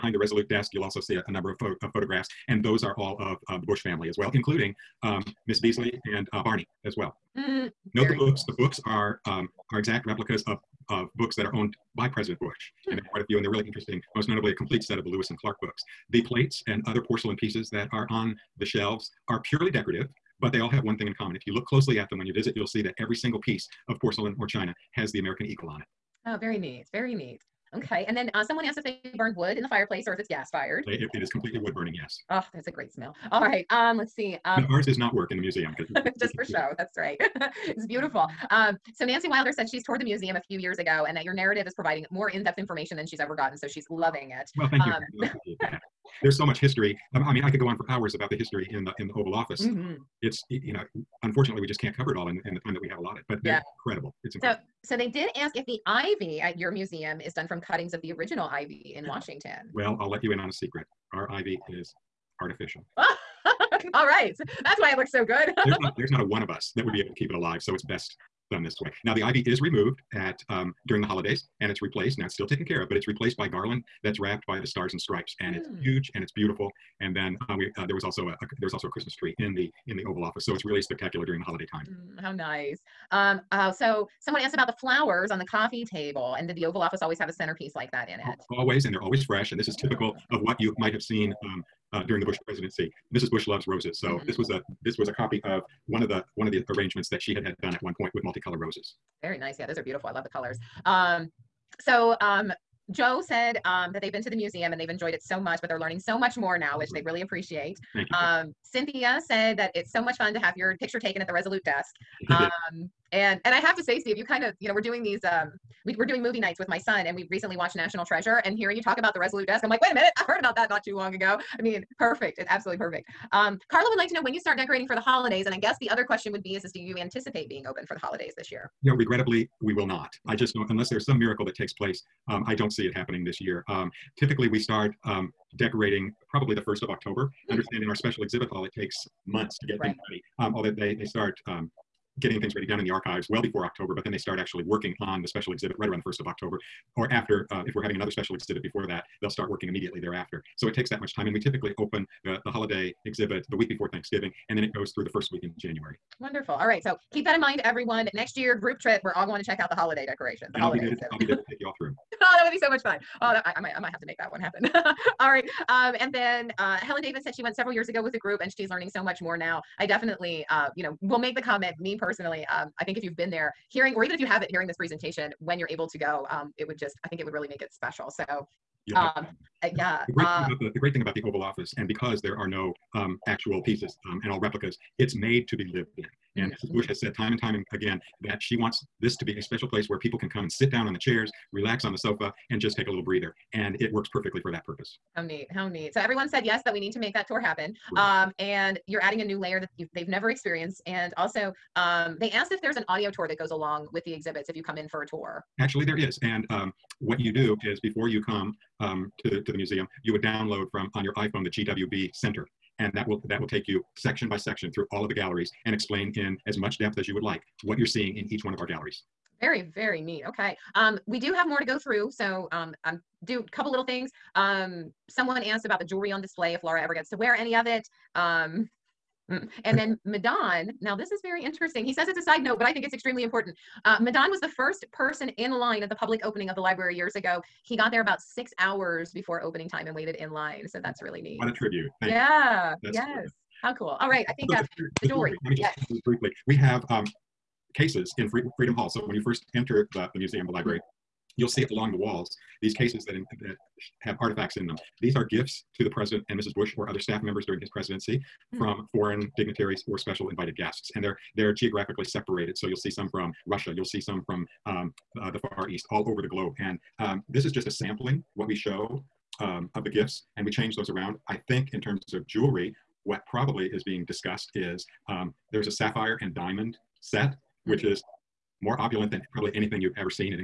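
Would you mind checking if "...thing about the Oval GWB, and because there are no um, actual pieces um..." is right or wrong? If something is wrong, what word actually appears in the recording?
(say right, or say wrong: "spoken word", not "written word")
wrong: "Office", not "GWB".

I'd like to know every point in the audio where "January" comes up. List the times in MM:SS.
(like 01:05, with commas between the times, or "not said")
02:35.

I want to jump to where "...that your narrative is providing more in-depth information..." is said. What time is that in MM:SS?
00:41.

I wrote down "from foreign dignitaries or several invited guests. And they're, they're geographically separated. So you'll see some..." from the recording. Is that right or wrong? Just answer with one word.
wrong.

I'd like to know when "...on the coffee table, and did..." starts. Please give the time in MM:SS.
01:25.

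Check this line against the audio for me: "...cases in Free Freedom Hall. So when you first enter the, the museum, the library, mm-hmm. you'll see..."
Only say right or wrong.
right.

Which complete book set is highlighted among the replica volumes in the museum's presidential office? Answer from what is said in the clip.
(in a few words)
Lewis and Clark.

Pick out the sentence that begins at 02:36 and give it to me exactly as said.
So keep that in mind, everyone.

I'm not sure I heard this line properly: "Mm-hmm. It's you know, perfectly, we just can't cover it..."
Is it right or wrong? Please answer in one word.
wrong.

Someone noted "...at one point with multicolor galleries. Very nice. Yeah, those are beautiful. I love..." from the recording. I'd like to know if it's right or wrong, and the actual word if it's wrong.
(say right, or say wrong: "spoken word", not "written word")
wrong: "roses", not "galleries".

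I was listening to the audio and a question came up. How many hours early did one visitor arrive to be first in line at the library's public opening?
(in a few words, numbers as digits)
6.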